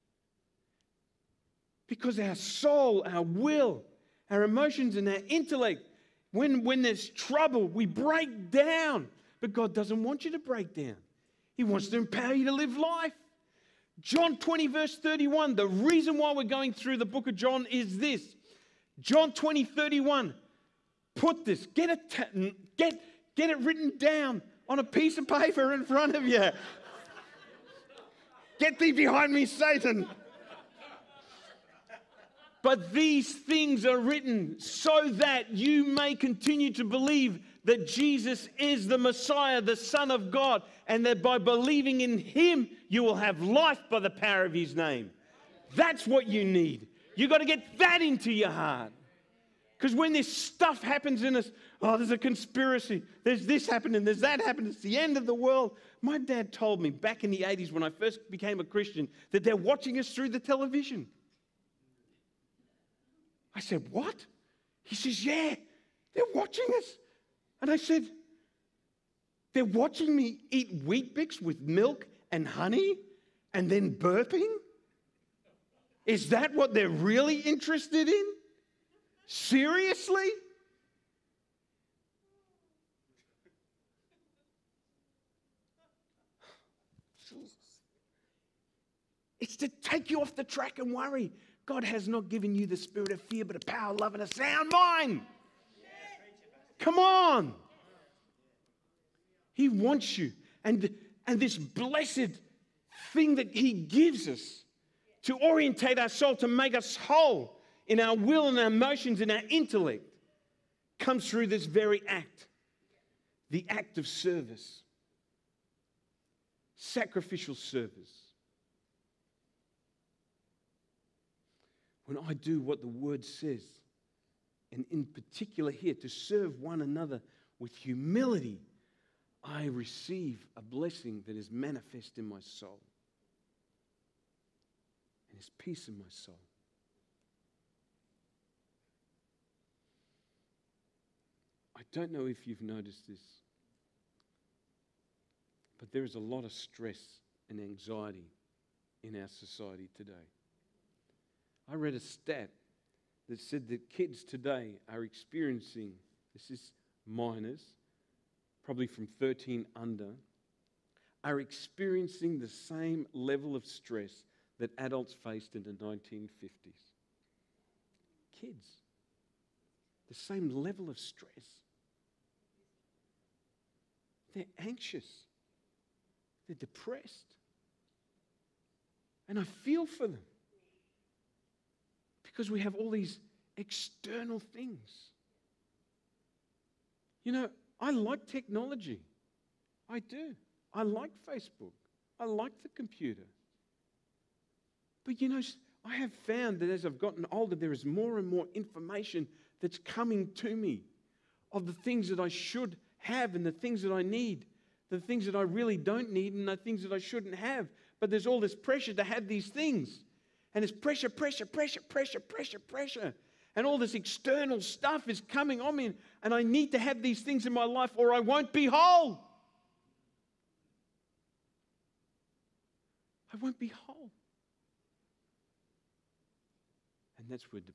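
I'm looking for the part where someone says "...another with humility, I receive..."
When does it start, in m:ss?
2:06.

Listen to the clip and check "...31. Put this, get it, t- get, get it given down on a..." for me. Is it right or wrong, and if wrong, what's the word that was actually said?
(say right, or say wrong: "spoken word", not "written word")
wrong: "written", not "given".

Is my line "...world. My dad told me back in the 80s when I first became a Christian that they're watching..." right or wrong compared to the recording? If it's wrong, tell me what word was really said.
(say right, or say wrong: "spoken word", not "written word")
right.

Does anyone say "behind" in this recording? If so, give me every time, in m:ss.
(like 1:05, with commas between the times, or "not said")
0:28.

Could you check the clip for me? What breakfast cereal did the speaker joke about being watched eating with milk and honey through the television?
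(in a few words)
Weet-Bix.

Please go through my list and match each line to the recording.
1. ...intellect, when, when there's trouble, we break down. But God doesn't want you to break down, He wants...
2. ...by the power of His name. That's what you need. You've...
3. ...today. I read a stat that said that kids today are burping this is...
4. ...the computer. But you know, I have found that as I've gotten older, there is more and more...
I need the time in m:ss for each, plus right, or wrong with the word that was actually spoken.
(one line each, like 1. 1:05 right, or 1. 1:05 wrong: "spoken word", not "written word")
1. 0:05 right
2. 0:43 right
3. 2:29 wrong: "experiencing", not "burping"
4. 3:12 right.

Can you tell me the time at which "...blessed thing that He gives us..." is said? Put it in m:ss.
1:41.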